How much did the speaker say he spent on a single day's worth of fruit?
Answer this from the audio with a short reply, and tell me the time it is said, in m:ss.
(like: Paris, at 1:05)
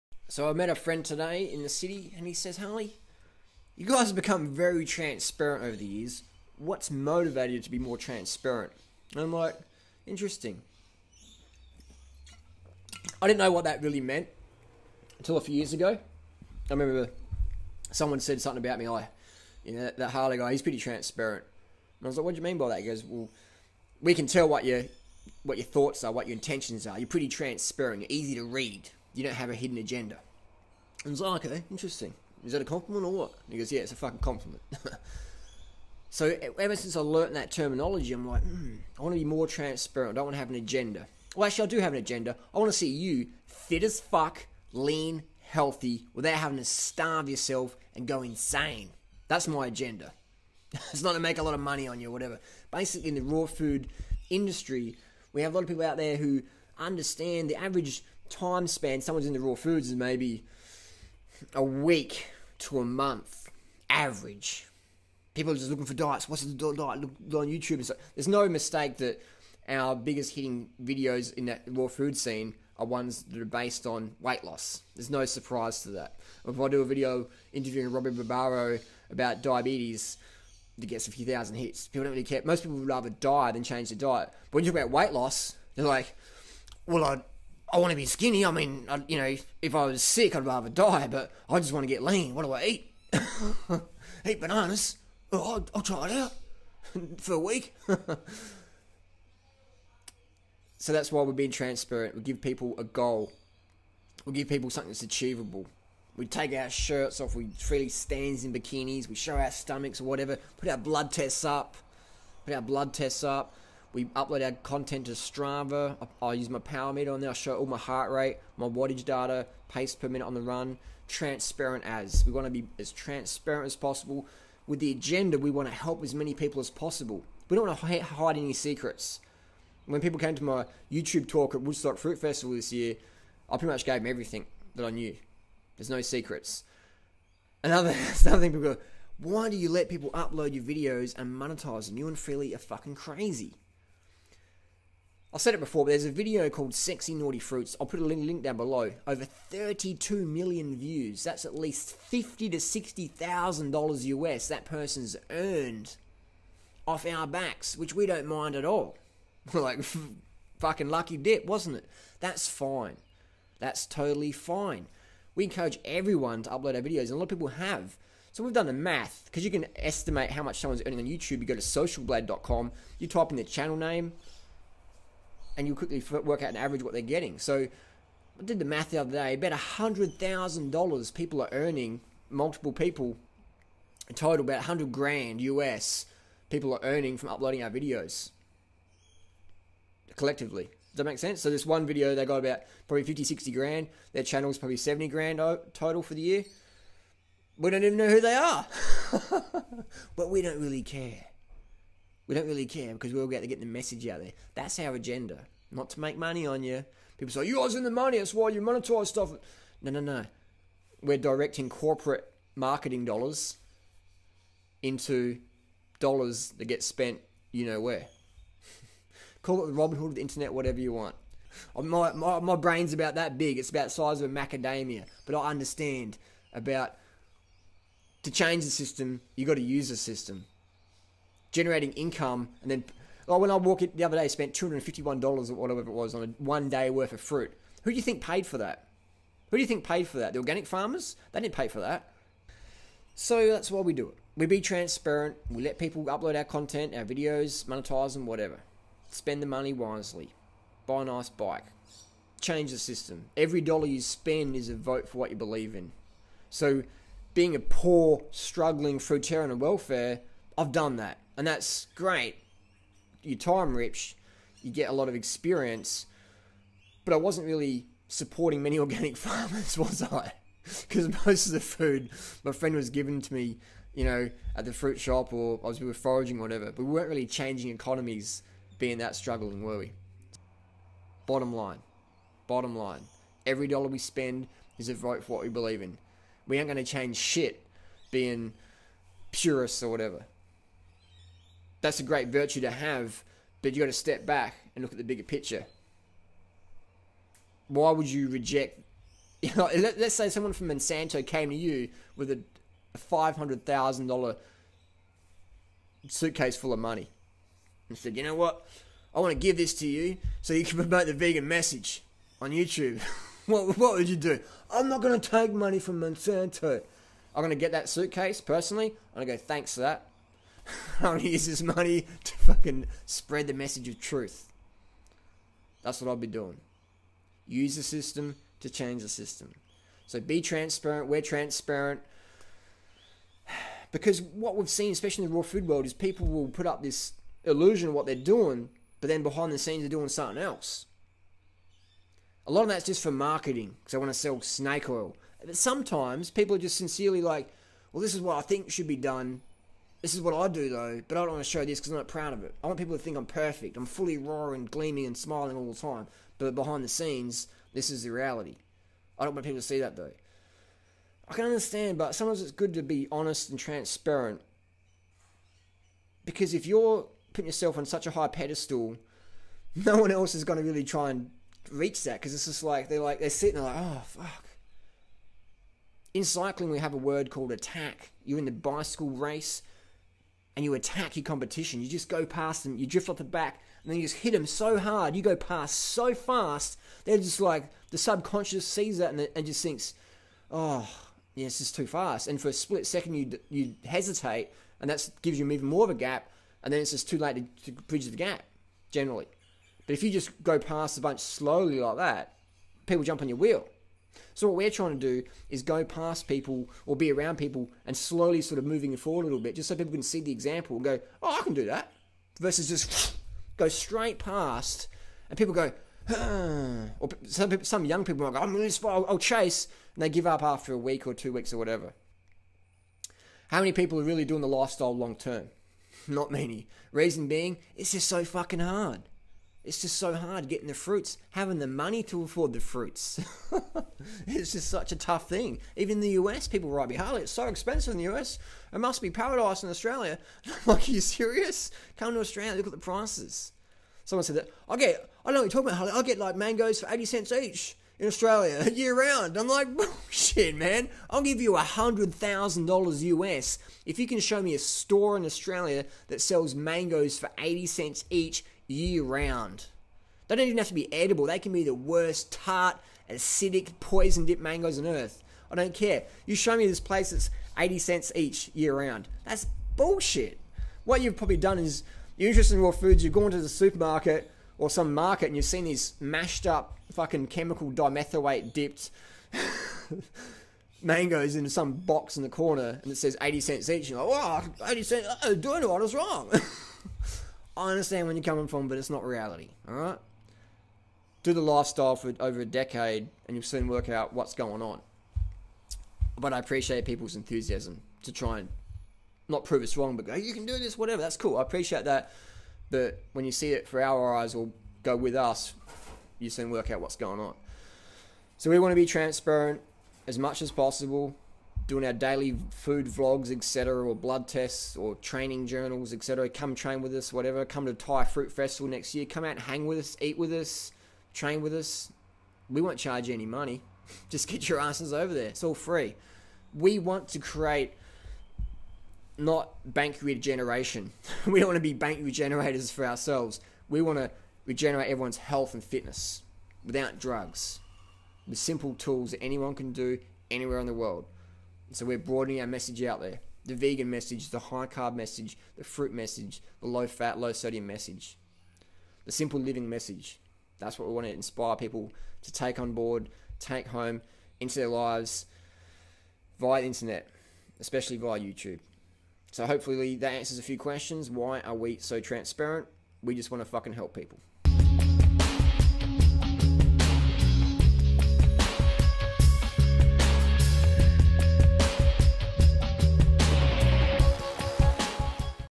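$251, at 3:54.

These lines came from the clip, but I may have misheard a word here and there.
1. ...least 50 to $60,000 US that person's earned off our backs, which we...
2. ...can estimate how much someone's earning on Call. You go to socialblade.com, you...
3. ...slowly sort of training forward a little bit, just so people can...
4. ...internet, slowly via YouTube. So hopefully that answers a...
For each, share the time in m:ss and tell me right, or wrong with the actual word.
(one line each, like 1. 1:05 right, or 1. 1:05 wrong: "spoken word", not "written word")
1. 2:31 right
2. 2:49 wrong: "YouTube", not "Call"
3. 6:47 wrong: "moving", not "training"
4. 9:16 wrong: "especially", not "slowly".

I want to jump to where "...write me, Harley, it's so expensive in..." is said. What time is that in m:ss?
7:16.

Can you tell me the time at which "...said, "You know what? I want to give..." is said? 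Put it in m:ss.
5:07.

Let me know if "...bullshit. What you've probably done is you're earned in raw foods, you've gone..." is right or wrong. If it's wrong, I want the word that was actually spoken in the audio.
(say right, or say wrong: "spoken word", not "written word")
wrong: "interested", not "earned".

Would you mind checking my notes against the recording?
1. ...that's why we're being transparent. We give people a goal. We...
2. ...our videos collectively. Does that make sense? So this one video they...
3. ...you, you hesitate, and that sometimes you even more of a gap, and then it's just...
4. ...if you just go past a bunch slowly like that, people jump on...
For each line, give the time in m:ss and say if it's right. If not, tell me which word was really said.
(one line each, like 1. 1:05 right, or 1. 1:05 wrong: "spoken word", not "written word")
1. 1:40 right
2. 3:07 right
3. 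6:33 wrong: "gives", not "sometimes"
4. 6:39 right.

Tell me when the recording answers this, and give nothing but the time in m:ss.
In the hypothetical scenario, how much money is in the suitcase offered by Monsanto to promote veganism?
5:02.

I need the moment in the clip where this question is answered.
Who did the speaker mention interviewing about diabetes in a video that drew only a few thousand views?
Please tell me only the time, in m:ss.
1:17.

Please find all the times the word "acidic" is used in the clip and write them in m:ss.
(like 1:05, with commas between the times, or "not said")
7:43.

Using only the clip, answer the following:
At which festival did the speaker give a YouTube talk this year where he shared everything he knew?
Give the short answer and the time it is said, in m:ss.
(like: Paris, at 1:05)
Woodstock Fruit Festival, at 2:11.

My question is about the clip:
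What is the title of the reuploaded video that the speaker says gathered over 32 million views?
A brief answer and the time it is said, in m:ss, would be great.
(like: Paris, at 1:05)
Sexy Naughty Fruits, at 2:26.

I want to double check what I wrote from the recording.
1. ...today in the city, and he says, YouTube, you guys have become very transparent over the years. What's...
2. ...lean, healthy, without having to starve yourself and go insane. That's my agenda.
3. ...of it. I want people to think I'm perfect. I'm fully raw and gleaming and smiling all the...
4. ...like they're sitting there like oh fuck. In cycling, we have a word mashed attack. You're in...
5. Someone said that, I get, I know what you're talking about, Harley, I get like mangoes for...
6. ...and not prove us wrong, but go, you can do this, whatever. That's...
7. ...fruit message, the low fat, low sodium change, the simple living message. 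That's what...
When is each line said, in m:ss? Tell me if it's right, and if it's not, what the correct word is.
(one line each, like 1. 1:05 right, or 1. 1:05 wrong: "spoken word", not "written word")
1. 0:01 wrong: "Harley", not "YouTube"
2. 0:44 right
3. 5:52 right
4. 6:12 wrong: "called", not "mashed"
5. 7:24 right
6. 8:18 right
7. 9:05 wrong: "message", not "change".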